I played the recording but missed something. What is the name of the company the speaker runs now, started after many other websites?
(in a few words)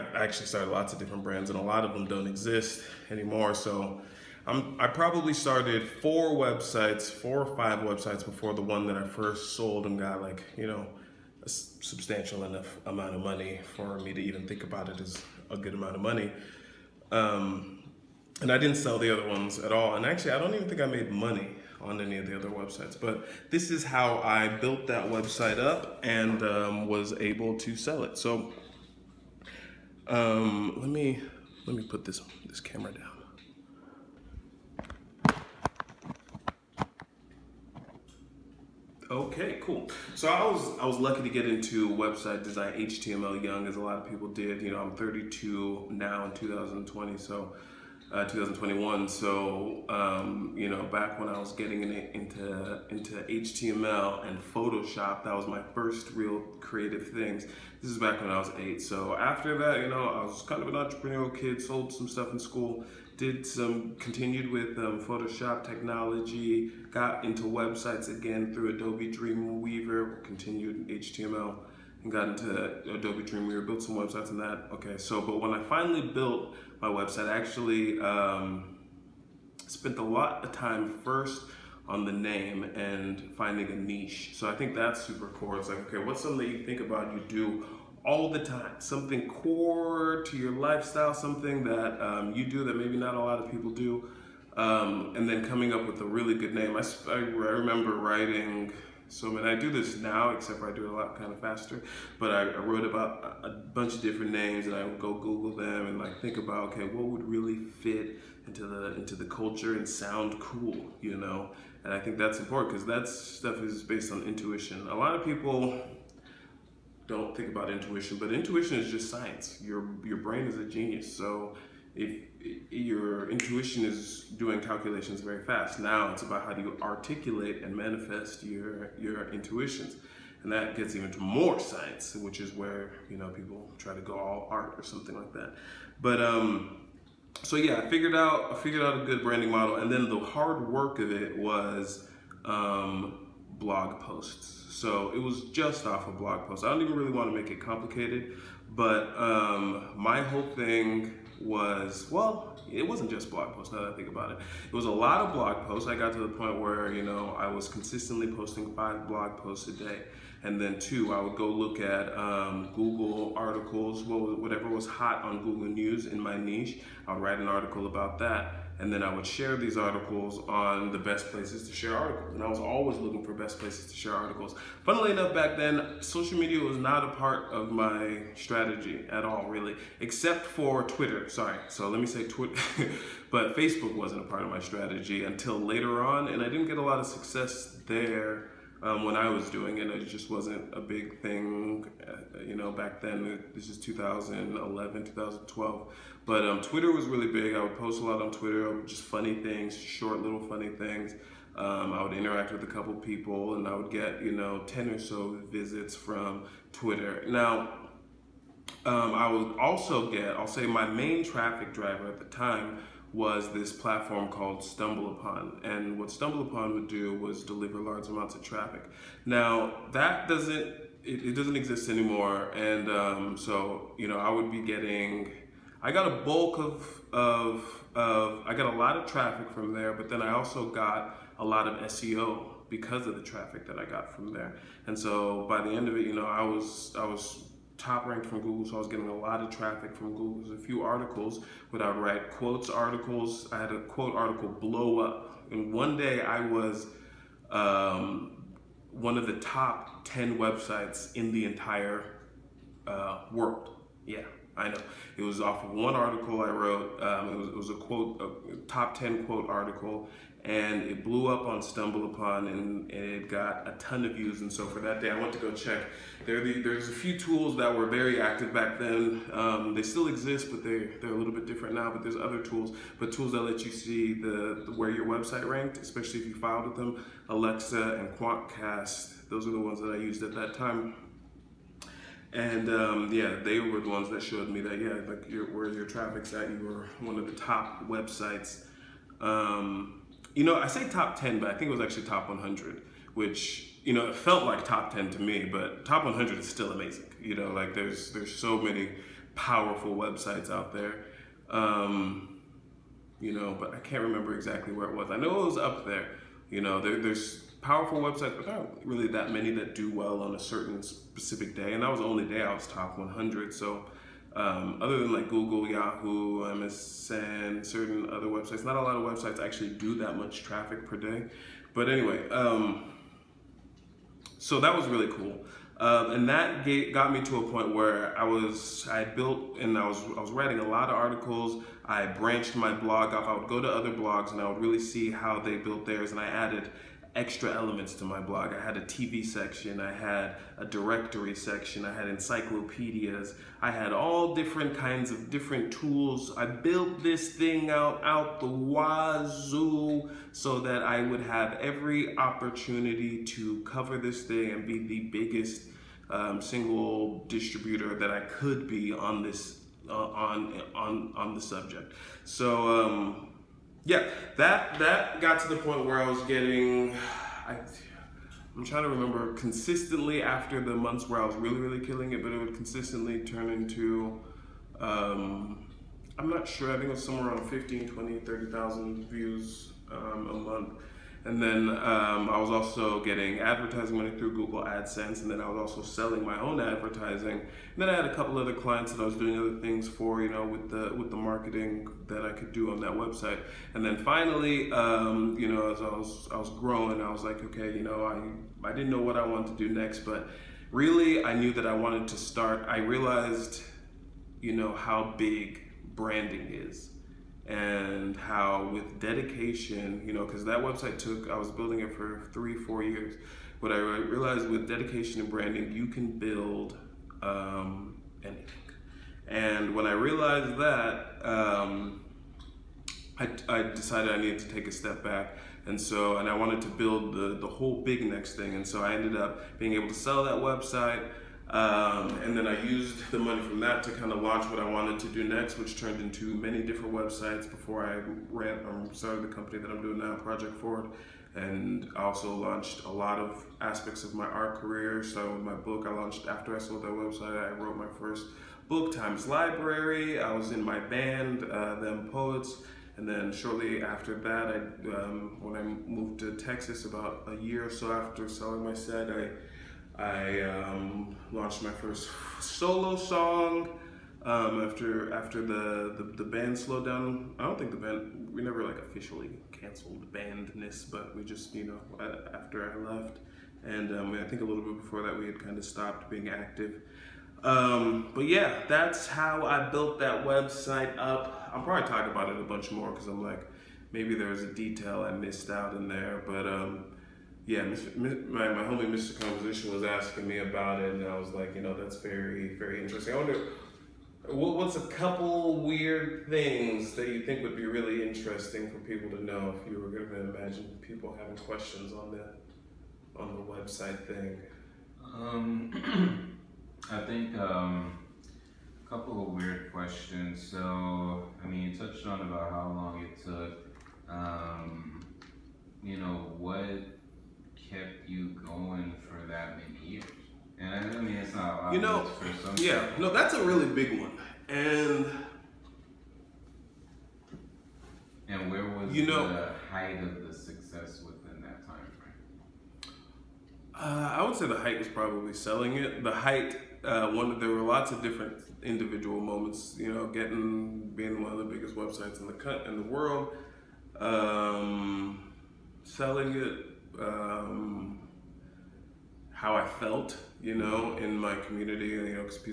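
Project Forward.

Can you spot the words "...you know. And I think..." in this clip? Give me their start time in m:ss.
1:51.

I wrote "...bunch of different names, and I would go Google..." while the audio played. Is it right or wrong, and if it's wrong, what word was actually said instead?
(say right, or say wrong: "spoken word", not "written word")
right.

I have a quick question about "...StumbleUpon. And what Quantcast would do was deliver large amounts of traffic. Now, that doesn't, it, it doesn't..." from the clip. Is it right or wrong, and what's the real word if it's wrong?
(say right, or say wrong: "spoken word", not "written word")
wrong: "StumbleUpon", not "Quantcast".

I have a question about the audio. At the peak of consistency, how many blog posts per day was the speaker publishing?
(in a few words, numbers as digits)
5.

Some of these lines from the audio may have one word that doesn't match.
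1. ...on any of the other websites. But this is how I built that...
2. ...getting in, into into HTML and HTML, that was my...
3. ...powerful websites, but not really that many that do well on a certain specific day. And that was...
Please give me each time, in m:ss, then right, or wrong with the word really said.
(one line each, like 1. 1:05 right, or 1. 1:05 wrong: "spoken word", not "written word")
1. 0:21 right
2. 0:51 wrong: "Photoshop", not "HTML"
3. 5:07 right.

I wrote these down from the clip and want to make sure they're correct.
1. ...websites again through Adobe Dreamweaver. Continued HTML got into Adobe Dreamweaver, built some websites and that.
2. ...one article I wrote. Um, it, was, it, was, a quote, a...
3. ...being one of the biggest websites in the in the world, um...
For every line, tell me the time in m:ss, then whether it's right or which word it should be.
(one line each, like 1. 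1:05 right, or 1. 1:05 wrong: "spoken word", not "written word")
1. 1:07 right
2. 4:15 right
3. 9:00 right.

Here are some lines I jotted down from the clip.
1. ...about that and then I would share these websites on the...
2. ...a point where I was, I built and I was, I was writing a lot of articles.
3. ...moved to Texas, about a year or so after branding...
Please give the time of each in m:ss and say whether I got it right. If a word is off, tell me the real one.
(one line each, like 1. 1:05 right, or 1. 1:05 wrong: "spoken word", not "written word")
1. 2:47 wrong: "articles", not "websites"
2. 5:27 right
3. 7:35 wrong: "selling", not "branding".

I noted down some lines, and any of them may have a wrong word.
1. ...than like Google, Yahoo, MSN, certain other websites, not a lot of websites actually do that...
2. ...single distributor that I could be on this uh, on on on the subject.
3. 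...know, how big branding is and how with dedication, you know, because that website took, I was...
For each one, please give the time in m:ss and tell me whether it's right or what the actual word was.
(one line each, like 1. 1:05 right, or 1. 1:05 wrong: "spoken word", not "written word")
1. 5:14 right
2. 5:56 right
3. 6:44 right.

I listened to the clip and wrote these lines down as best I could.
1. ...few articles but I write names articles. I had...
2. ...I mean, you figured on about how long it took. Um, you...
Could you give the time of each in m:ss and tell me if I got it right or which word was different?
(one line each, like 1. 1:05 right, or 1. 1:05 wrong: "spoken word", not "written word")
1. 4:00 wrong: "quotes", not "names"
2. 8:30 wrong: "touched", not "figured".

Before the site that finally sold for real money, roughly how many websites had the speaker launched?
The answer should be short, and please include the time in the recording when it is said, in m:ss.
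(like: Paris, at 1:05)
4 or 5, at 0:06.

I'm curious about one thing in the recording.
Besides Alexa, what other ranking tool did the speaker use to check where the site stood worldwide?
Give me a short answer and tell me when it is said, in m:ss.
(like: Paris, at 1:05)
Quantcast, at 4:38.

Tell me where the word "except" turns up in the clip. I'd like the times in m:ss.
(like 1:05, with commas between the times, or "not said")
1:40, 3:00.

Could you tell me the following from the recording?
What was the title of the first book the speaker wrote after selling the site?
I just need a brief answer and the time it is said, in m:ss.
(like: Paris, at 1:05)
Times Library, at 7:28.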